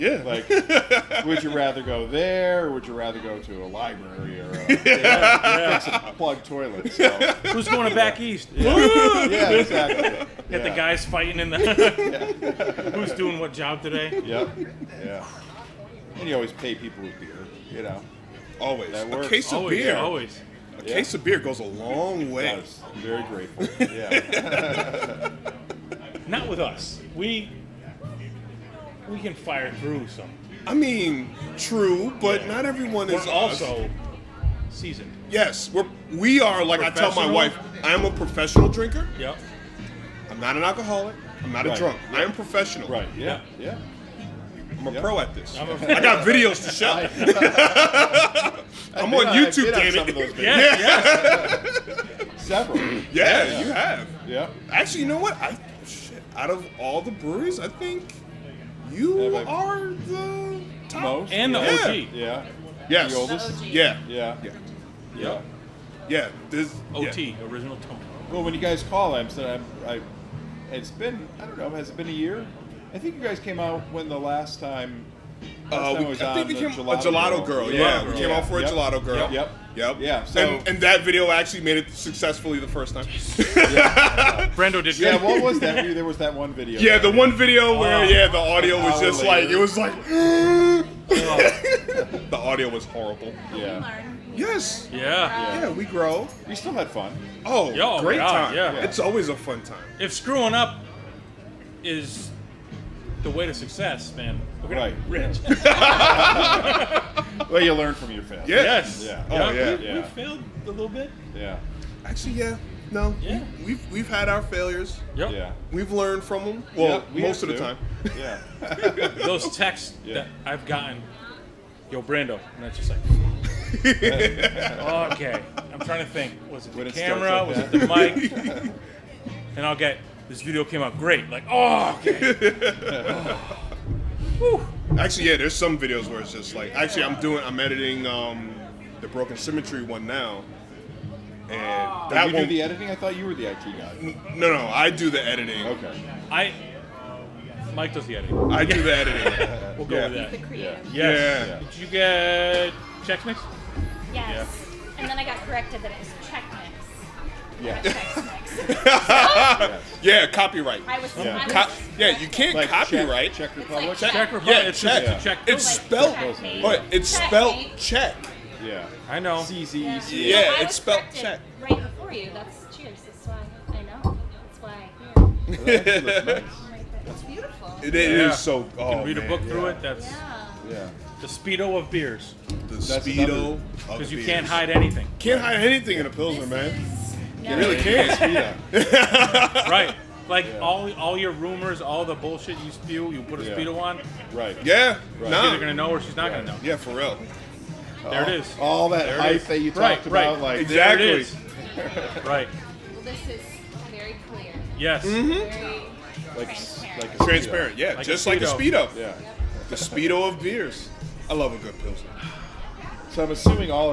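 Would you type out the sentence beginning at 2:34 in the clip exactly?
And then I got corrected that it was yeah.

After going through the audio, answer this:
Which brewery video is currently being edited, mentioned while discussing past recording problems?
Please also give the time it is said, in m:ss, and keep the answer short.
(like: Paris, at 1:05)
Broken Symmetry, at 2:19.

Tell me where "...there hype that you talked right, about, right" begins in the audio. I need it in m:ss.
3:19.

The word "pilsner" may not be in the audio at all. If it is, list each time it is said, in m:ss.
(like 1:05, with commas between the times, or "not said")
3:06, 3:31.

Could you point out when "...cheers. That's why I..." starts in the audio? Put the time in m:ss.
2:52.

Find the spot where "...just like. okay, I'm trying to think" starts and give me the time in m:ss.
2:02.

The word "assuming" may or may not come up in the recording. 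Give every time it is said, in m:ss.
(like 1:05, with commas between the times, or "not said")
3:33.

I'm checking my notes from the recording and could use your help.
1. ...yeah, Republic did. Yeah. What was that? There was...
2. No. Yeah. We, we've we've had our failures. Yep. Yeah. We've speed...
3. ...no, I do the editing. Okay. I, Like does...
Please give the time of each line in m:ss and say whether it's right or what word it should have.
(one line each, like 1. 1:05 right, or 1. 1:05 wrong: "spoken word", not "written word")
1. 1:23 wrong: "Brando", not "Republic"
2. 1:52 wrong: "learned", not "speed"
3. 2:24 wrong: "Mike", not "Like".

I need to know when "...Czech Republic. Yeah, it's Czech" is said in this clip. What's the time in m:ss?
2:44.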